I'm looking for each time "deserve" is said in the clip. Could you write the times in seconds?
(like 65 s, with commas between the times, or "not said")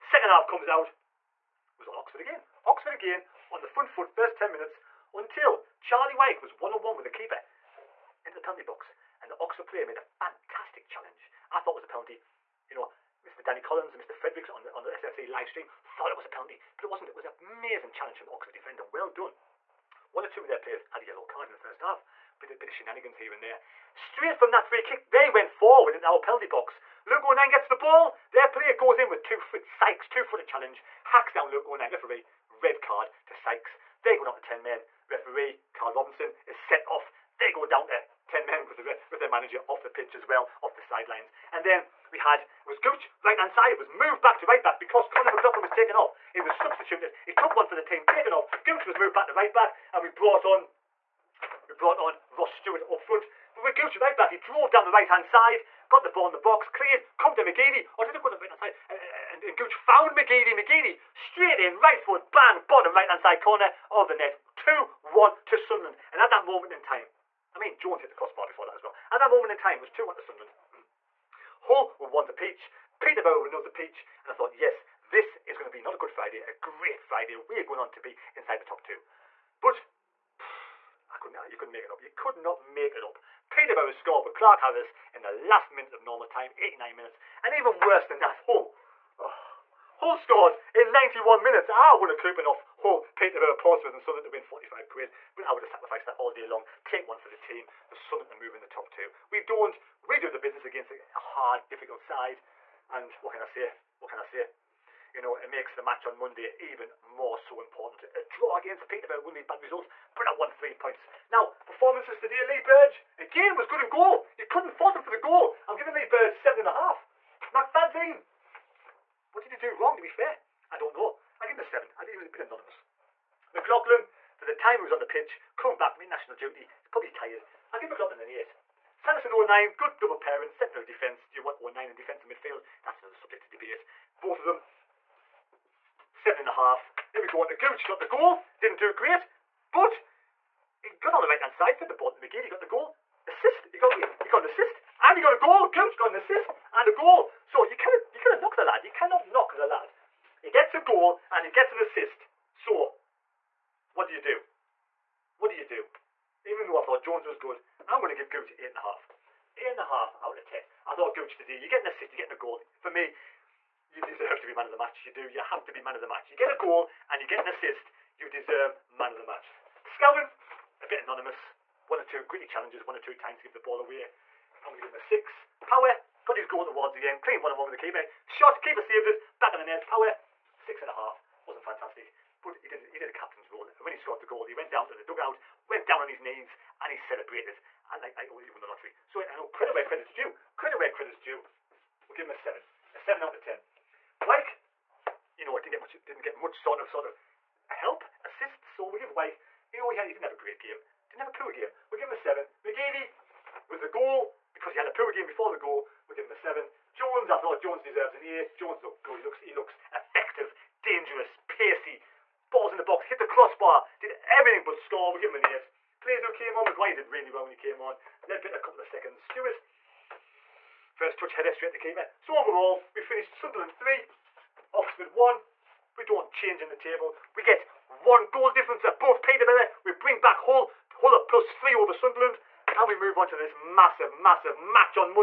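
164 s, 168 s, 207 s.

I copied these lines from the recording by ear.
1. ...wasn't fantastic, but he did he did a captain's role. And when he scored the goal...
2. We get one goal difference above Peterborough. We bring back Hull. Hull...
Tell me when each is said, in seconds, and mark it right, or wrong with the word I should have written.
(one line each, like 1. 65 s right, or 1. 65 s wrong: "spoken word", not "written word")
1. 181 s right
2. 227 s right.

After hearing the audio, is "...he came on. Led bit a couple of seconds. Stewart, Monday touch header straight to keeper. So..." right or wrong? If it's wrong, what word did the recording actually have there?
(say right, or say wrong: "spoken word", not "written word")
wrong: "First", not "Monday".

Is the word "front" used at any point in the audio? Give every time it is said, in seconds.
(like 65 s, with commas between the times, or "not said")
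3 s, 52 s.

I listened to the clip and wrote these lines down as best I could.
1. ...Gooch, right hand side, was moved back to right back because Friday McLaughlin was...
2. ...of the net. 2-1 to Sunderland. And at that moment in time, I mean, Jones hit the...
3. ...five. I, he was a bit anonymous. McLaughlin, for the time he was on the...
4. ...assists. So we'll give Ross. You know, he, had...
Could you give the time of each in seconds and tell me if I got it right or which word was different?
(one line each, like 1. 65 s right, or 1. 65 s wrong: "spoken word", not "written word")
1. 42 s wrong: "Conor", not "Friday"
2. 63 s right
3. 121 s wrong: "seven", not "five"
4. 198 s wrong: "Wyke", not "Ross".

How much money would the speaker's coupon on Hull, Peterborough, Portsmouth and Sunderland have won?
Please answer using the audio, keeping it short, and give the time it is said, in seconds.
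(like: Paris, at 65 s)
45 quid, at 94 s.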